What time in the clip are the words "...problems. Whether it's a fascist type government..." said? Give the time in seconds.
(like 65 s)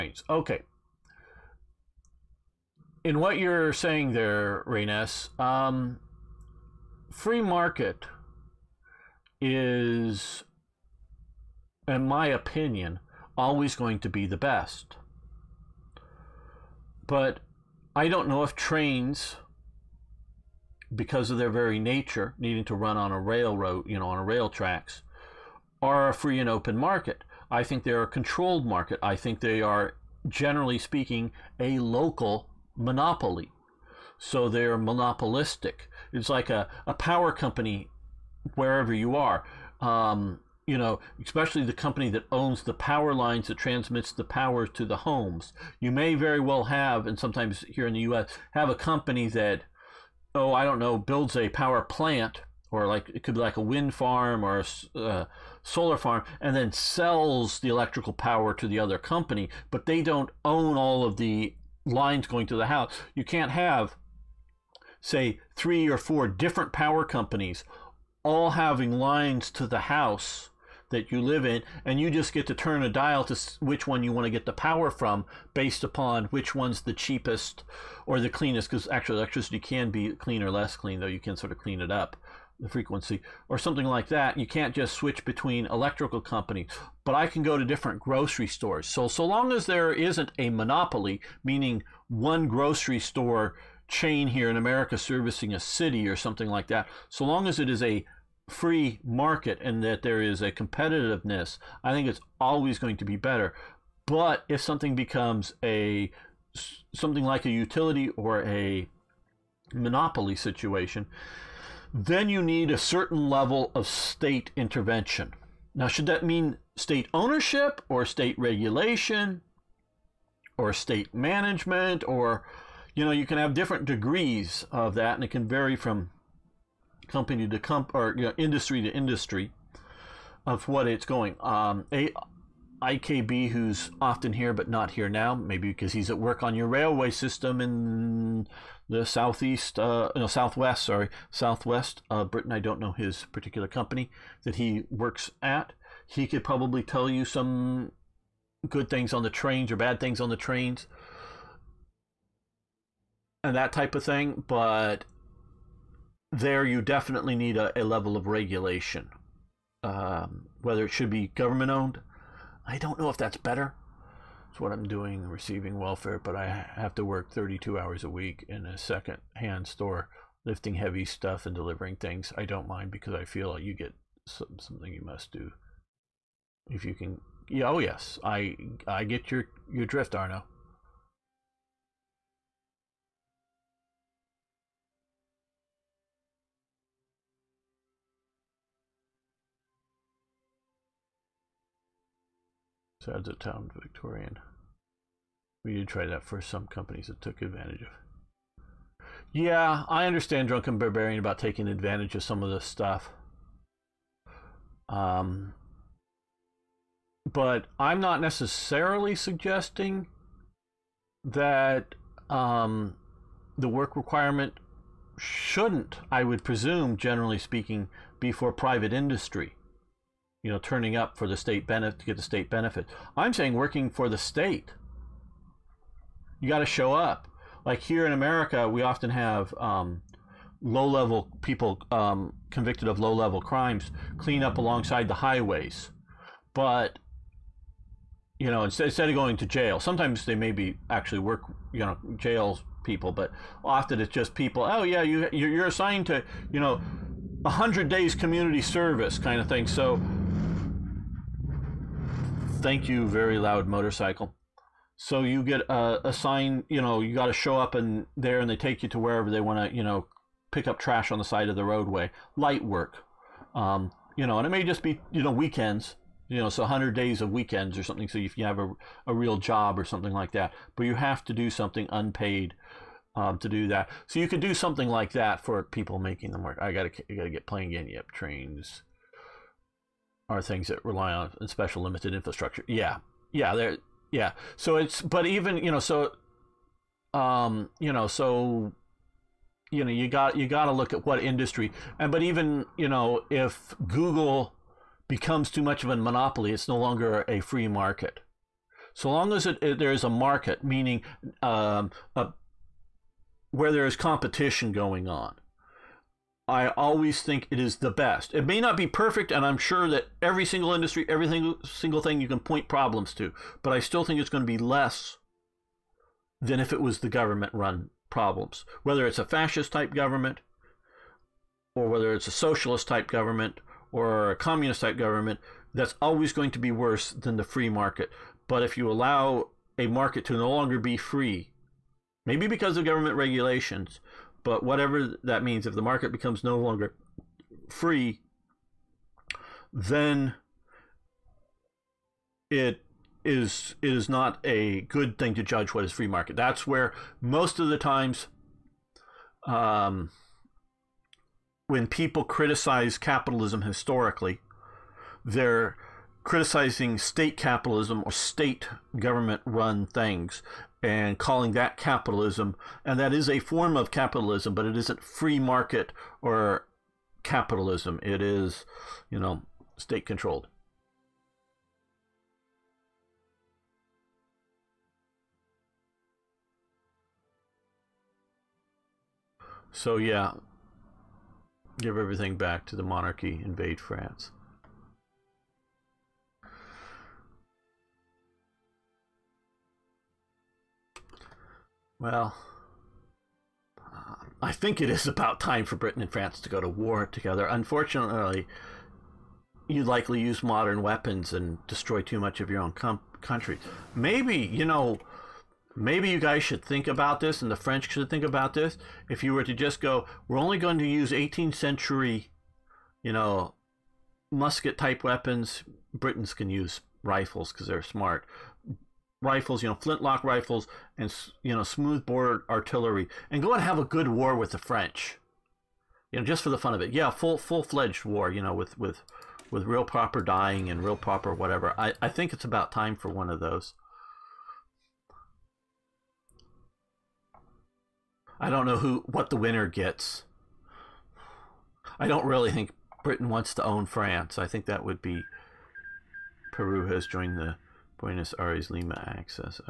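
318 s.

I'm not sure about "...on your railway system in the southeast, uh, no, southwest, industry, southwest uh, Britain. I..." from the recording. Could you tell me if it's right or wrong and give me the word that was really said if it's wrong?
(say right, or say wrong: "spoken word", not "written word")
wrong: "sorry", not "industry".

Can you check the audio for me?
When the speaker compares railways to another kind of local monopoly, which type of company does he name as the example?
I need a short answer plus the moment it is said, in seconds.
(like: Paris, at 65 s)
power company, at 36 s.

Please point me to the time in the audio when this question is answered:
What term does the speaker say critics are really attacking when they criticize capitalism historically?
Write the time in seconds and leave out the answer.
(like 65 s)
356 s.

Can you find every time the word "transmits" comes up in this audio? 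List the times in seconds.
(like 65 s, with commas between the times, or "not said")
43 s.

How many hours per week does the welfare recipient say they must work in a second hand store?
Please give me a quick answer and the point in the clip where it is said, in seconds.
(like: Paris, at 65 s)
32, at 167 s.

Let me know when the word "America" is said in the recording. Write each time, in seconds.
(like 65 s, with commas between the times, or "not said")
94 s, 228 s.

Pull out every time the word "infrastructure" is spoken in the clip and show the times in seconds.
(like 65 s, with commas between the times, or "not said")
282 s.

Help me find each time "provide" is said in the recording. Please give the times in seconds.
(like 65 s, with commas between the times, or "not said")
not said.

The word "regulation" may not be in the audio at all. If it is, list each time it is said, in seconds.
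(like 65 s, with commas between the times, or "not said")
118 s, 158 s, 333 s.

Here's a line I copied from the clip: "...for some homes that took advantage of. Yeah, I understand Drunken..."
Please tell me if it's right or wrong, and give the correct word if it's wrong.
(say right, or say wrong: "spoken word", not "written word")
wrong: "companies", not "homes".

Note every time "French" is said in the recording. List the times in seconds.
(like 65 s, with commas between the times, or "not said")
407 s, 424 s.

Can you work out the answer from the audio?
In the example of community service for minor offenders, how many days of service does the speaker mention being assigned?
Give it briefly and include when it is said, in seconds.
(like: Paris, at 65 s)
100, at 247 s.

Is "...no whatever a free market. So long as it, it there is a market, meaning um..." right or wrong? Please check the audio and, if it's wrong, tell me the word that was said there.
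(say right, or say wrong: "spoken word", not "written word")
wrong: "longer", not "whatever".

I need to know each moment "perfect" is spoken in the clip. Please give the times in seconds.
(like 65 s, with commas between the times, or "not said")
308 s.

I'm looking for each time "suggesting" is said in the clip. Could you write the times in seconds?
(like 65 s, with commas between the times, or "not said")
209 s.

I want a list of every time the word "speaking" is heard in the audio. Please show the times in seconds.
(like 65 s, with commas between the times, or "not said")
30 s, 217 s.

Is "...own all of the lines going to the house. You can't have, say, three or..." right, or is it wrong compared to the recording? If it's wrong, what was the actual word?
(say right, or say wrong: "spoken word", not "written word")
right.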